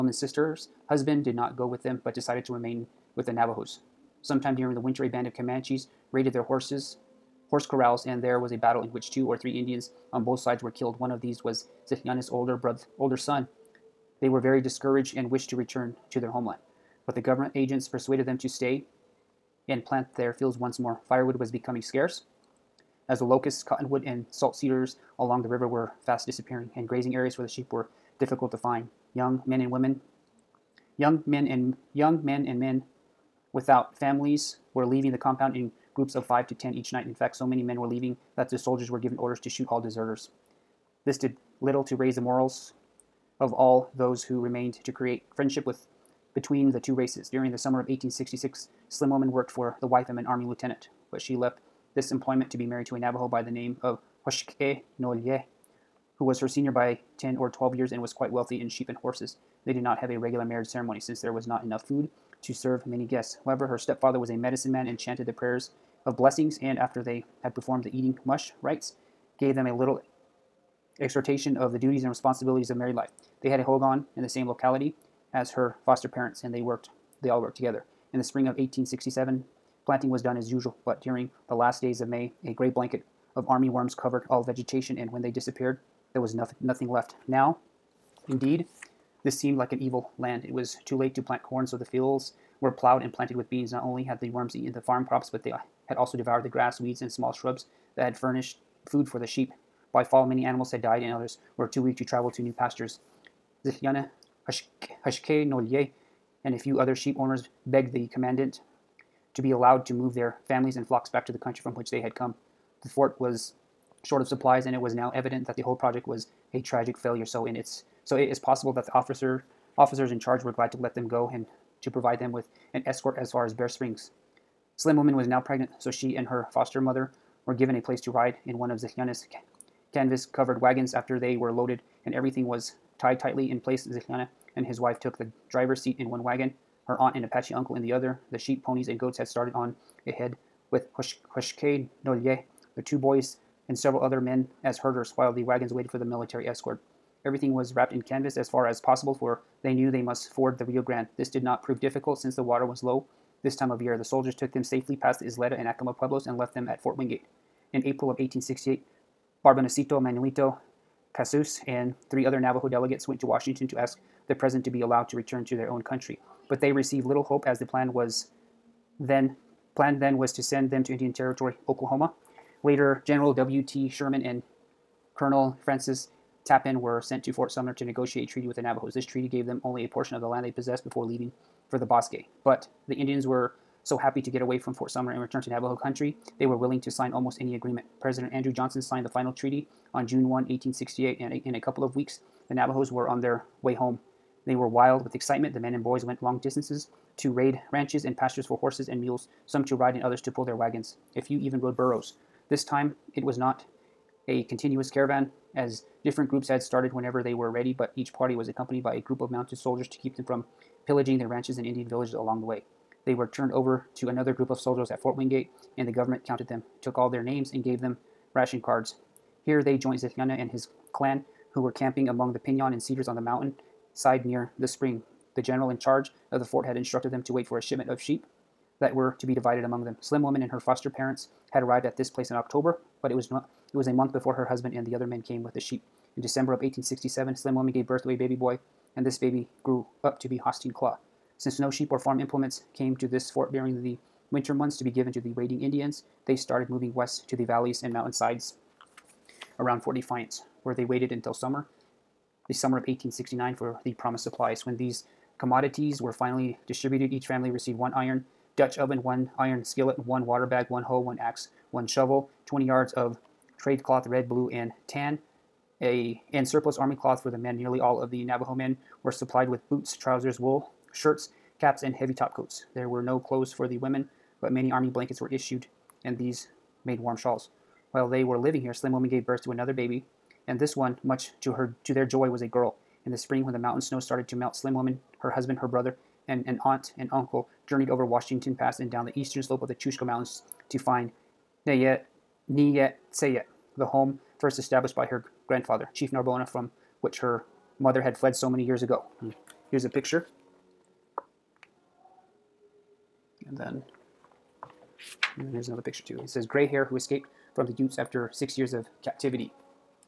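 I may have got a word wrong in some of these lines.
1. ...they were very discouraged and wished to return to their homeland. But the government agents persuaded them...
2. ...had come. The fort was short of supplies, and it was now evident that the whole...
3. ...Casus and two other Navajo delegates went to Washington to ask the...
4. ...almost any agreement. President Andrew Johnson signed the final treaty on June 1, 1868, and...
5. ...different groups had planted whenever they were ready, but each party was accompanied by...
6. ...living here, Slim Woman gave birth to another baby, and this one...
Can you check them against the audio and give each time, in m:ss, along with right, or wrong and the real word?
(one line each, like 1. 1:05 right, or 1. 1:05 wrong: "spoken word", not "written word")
1. 0:14 right
2. 1:52 right
3. 2:41 wrong: "three", not "two"
4. 3:07 right
5. 3:26 wrong: "started", not "planted"
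6. 4:38 right.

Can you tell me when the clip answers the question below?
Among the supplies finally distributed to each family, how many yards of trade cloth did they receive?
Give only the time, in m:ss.
4:22.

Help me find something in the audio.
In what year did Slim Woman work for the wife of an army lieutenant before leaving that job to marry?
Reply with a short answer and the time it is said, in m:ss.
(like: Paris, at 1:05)
1866, at 0:47.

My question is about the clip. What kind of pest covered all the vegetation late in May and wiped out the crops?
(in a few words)
army worms.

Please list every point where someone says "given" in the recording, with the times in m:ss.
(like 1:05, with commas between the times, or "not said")
0:38, 2:07, 4:04.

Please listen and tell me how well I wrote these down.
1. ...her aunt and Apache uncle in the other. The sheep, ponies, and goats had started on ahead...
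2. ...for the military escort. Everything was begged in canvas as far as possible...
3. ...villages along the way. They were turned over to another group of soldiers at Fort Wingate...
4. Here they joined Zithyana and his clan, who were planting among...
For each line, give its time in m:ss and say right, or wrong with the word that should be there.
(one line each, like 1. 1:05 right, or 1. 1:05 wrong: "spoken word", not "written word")
1. 2:16 right
2. 2:25 wrong: "wrapped", not "begged"
3. 3:31 right
4. 3:39 wrong: "camping", not "planting".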